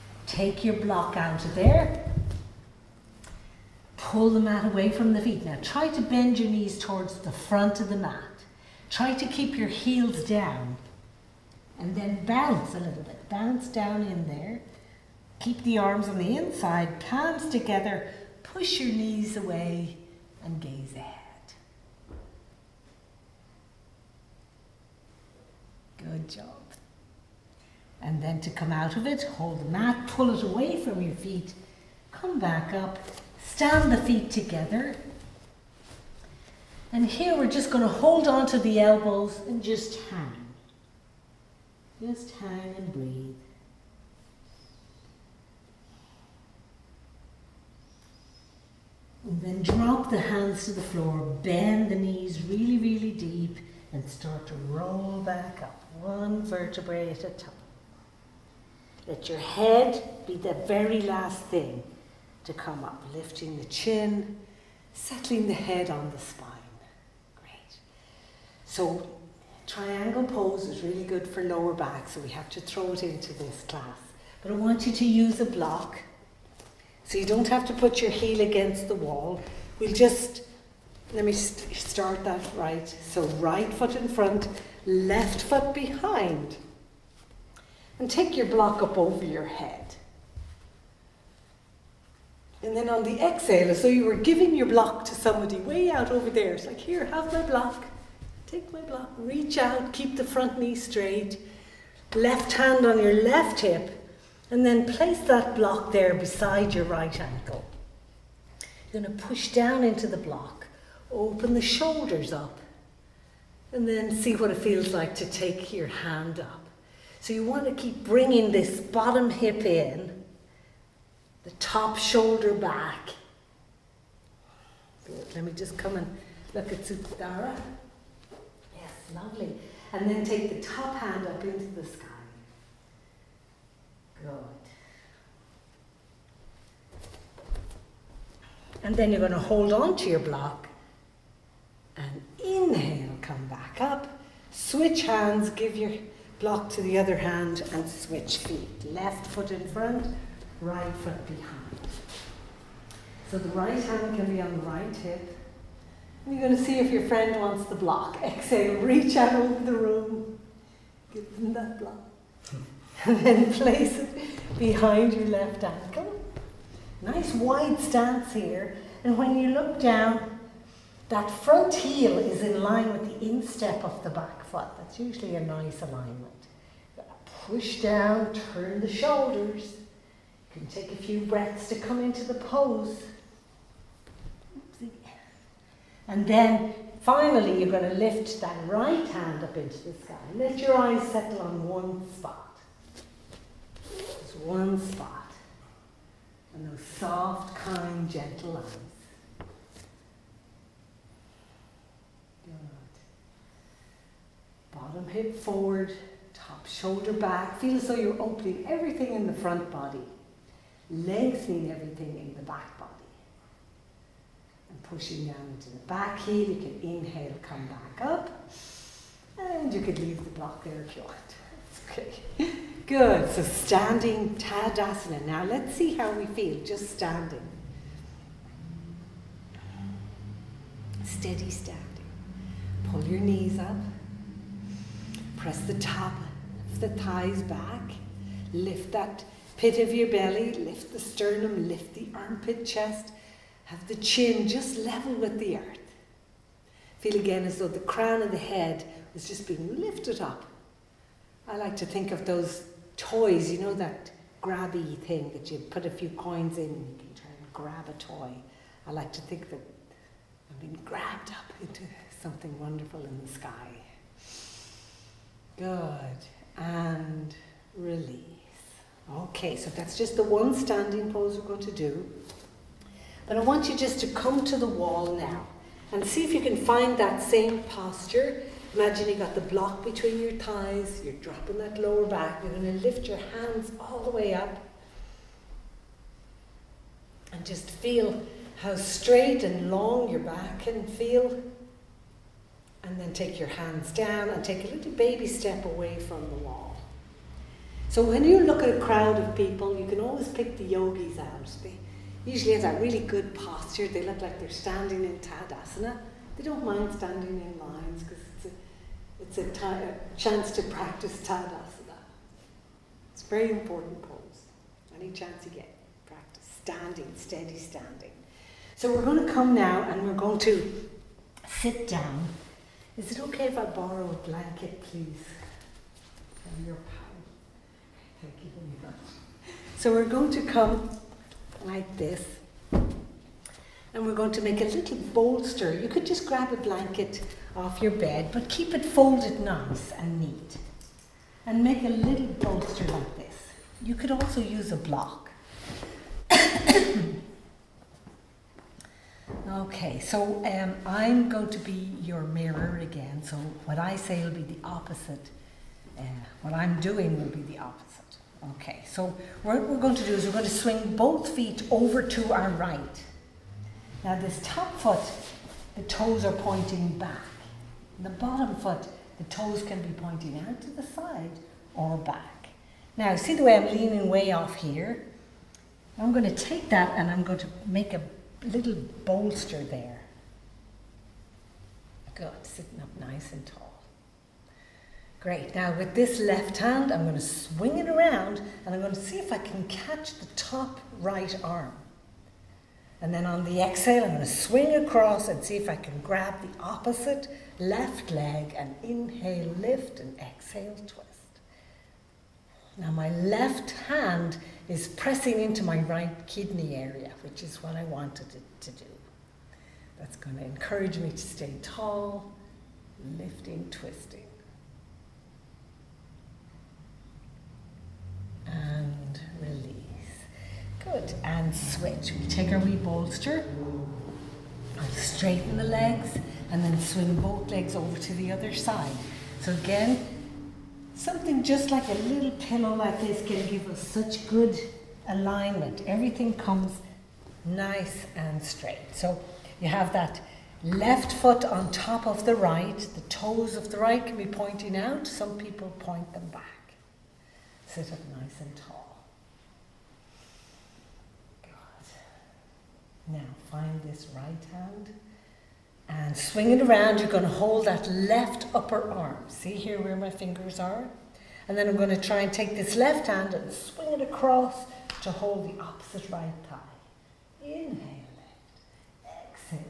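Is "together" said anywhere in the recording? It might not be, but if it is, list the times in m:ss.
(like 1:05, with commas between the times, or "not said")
0:17, 0:34.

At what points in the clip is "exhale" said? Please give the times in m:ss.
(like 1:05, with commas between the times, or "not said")
1:33, 2:38, 6:33, 6:40.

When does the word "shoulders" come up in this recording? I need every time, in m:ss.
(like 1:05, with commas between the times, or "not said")
1:51, 2:01, 2:58, 3:26.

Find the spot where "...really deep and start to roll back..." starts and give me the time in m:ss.
0:52.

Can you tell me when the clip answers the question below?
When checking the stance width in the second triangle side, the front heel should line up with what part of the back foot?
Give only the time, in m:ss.
2:53.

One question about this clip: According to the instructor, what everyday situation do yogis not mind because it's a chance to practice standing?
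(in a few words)
Standing in lines.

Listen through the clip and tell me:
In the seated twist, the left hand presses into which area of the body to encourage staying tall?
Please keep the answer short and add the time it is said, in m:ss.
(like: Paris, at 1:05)
Right kidney area, at 6:45.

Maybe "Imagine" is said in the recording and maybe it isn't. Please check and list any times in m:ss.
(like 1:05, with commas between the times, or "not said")
4:38.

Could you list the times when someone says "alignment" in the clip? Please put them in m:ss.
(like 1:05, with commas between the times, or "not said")
2:55, 7:15.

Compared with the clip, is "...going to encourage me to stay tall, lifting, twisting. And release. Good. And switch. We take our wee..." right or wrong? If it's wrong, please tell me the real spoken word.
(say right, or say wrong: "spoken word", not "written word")
right.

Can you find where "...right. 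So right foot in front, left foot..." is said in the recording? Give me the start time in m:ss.
1:22.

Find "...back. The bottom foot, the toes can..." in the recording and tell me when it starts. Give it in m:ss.
6:06.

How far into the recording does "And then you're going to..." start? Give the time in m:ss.
2:18.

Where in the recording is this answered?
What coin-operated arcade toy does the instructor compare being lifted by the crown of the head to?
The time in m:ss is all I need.
4:14.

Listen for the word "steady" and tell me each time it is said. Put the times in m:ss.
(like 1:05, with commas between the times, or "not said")
3:51, 5:17.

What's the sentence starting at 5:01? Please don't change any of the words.
They usually have that really good posture.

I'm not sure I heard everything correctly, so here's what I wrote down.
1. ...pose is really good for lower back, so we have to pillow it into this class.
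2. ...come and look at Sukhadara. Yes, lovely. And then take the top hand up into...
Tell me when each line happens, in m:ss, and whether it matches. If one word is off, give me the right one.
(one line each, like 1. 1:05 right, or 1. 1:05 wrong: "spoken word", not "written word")
1. 1:10 wrong: "throw", not "pillow"
2. 2:05 right.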